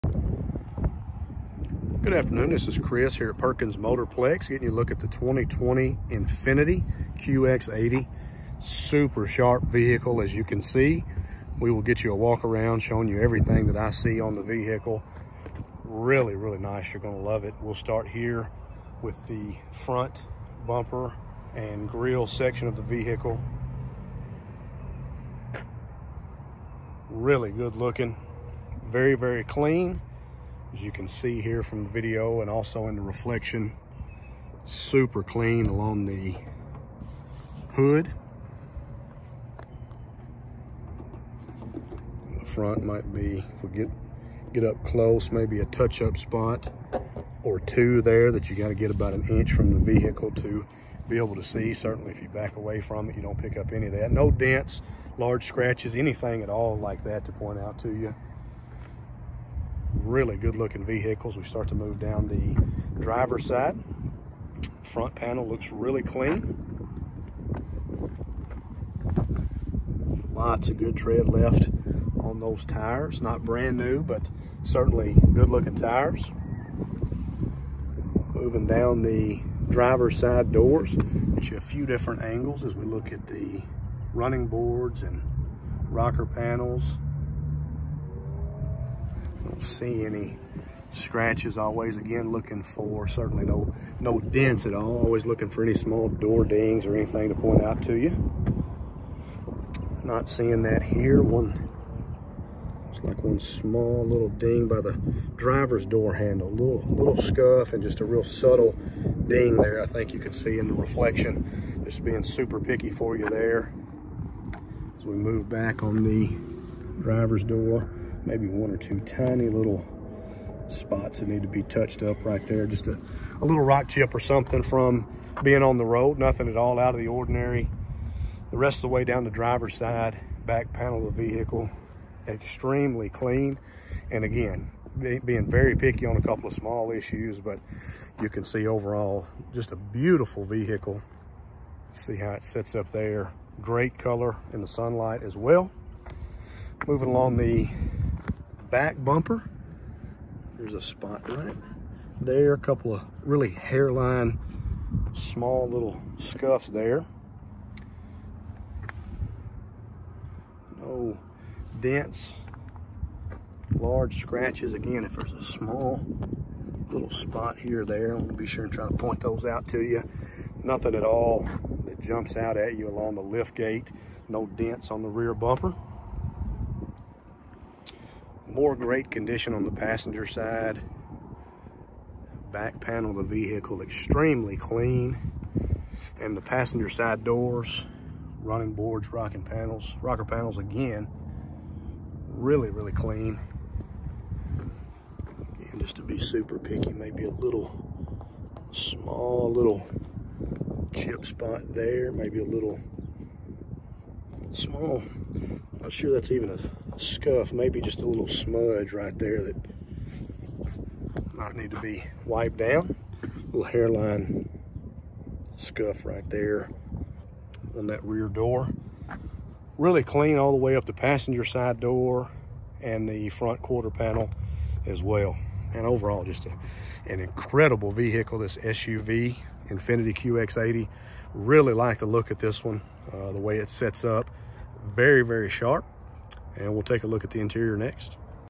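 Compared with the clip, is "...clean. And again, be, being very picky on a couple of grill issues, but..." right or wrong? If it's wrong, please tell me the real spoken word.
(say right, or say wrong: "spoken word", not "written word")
wrong: "small", not "grill".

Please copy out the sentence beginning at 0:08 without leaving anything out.
Super sharp vehicle, as you can see.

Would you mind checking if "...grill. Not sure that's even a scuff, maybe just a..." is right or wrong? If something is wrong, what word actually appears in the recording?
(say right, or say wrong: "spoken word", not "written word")
wrong: "small", not "grill".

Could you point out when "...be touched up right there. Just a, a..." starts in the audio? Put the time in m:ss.
2:01.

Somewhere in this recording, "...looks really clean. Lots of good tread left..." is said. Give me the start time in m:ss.
1:05.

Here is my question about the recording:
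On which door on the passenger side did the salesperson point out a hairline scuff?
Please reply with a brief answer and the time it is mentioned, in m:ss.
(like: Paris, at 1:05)
Rear door, at 3:38.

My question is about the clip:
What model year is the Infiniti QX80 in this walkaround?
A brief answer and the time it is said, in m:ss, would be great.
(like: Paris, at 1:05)
2020, at 0:05.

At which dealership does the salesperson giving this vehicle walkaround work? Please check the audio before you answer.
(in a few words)
Perkins Motorplex.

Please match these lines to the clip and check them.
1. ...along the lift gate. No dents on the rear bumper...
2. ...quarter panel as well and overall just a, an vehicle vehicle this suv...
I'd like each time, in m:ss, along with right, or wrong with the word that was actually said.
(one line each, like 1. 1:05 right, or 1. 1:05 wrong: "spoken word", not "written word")
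1. 2:52 right
2. 3:43 wrong: "incredible", not "vehicle".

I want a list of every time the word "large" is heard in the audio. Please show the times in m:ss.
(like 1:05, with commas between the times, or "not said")
0:55, 2:43.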